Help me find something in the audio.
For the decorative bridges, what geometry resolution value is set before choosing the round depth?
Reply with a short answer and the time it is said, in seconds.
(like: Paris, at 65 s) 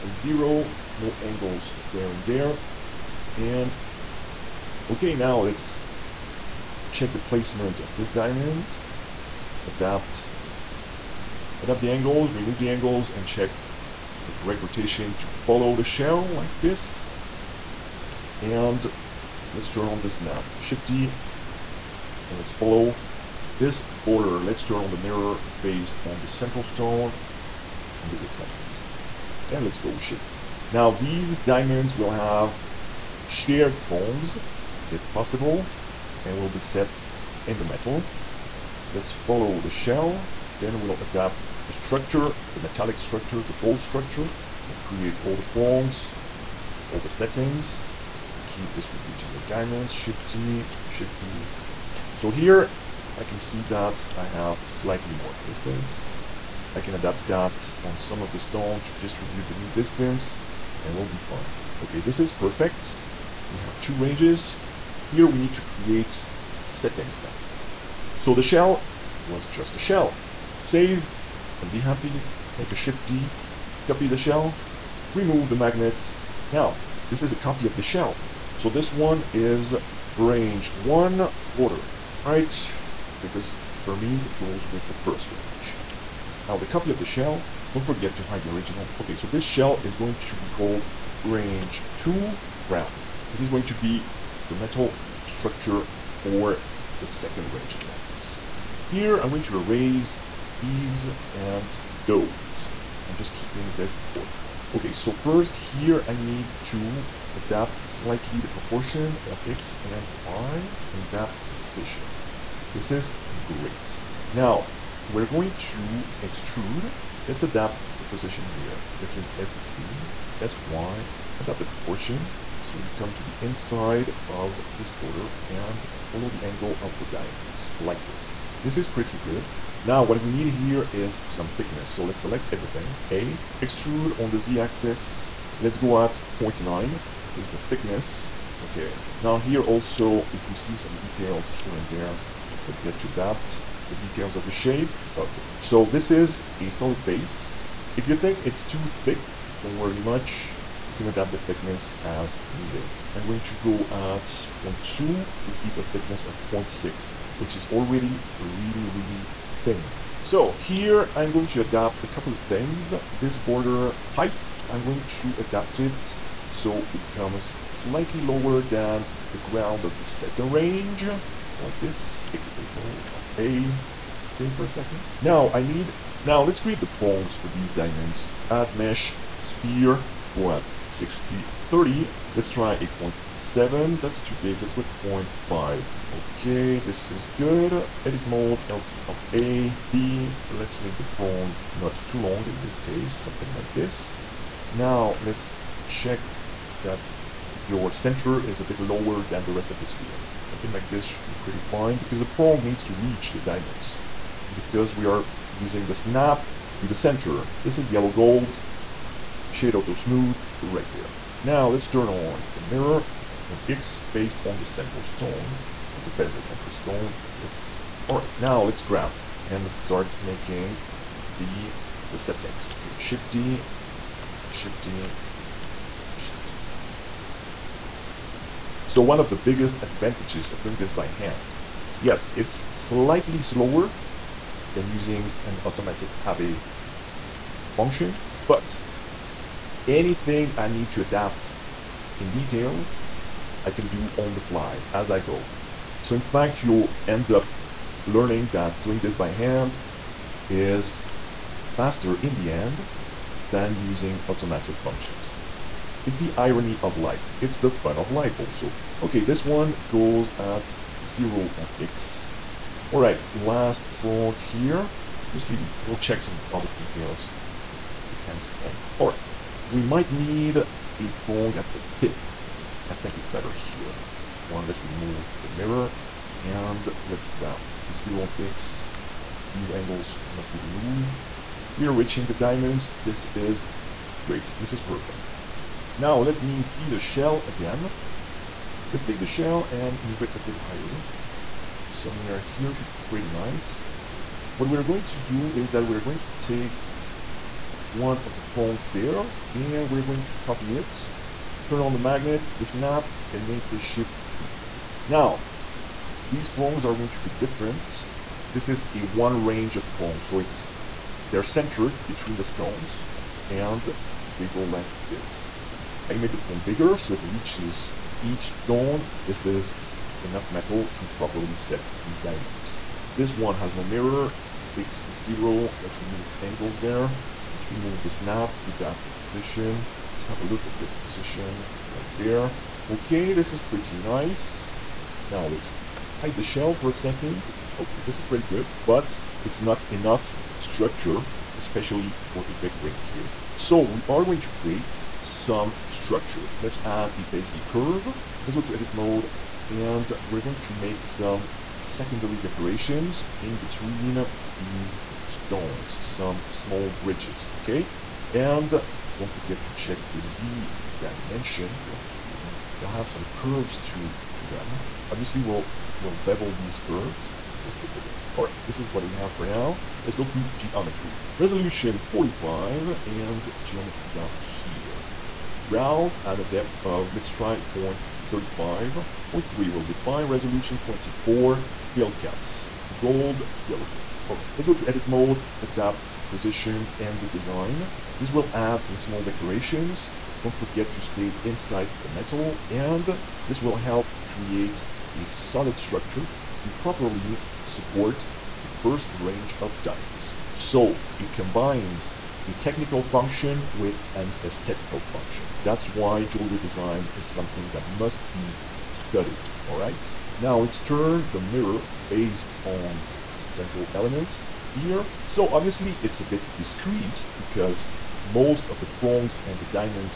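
45, at 371 s.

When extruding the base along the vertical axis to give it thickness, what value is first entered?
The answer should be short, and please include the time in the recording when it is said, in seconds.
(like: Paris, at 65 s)
0.9, at 136 s.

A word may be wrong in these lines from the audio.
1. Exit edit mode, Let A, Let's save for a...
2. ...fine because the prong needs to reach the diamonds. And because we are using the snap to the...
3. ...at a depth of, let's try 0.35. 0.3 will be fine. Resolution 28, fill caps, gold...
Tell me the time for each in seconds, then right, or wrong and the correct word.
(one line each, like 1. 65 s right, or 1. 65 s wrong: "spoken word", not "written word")
1. 172 s wrong: "Alt", not "Let"
2. 201 s right
3. 376 s wrong: "24", not "28".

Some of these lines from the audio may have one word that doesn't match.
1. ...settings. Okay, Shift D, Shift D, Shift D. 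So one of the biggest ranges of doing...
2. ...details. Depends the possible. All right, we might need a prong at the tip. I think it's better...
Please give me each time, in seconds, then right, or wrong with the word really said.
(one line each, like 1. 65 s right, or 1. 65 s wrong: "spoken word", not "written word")
1. 222 s wrong: "advantages", not "ranges"
2. 266 s wrong: "angle", not "possible".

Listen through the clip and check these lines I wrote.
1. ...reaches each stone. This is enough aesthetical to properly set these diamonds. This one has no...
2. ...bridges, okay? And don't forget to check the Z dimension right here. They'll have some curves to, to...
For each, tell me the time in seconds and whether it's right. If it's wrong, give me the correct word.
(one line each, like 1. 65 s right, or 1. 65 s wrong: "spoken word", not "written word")
1. 317 s wrong: "metal", not "aesthetical"
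2. 356 s right.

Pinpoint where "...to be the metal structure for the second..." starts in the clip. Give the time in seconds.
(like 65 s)
93 s.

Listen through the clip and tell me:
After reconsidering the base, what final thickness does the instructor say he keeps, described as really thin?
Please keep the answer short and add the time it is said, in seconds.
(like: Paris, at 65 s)
0.6, at 156 s.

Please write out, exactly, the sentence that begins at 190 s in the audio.
Let's make the prong not too long in this case, something like this.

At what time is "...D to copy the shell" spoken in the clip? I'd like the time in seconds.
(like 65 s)
73 s.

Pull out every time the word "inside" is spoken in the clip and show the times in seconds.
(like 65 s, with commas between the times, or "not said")
123 s, 391 s.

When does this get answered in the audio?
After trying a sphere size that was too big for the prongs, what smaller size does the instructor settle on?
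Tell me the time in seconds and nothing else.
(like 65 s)
185 s.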